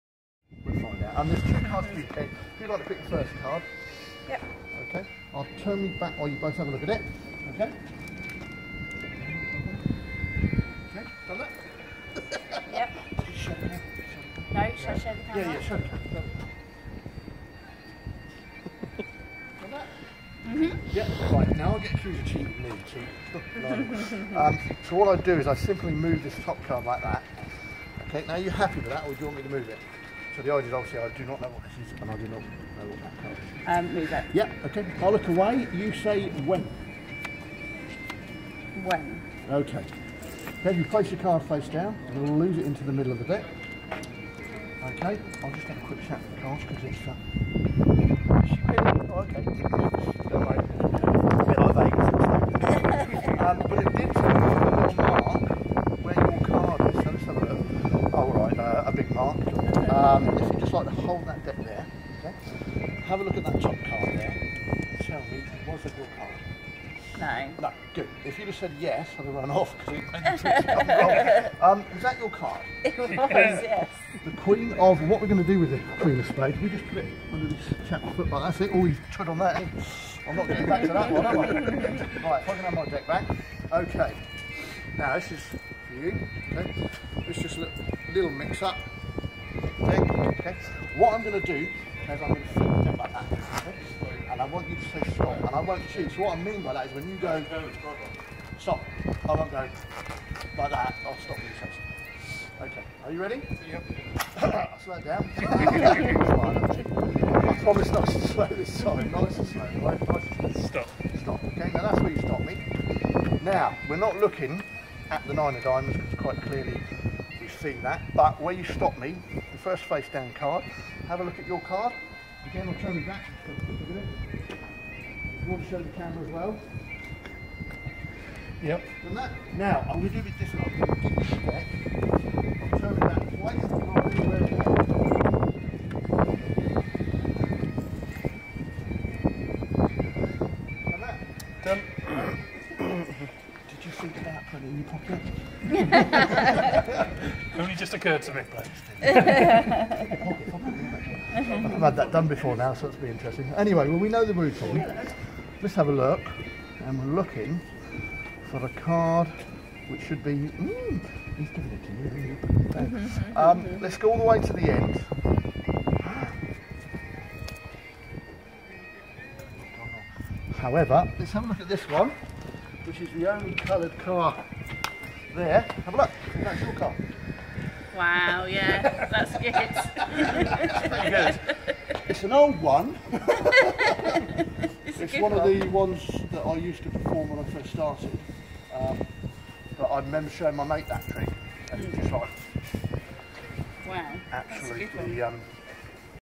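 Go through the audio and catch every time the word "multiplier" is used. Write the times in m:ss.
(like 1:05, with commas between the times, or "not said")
not said.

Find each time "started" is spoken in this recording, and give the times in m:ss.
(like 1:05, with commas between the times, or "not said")
3:07.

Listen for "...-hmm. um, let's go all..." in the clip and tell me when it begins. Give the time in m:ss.
2:42.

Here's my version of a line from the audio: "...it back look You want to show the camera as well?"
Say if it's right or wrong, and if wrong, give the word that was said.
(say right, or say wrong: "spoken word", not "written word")
right.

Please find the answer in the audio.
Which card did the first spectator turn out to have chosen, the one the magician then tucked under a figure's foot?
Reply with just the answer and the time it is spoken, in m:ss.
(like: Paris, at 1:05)
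Queen of Spades, at 1:15.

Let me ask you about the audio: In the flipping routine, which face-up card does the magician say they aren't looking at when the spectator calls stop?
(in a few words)
Nine of Diamonds.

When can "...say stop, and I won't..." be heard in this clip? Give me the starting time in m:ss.
1:34.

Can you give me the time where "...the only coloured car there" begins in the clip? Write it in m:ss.
2:53.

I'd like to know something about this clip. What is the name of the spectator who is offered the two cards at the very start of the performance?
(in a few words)
Kate.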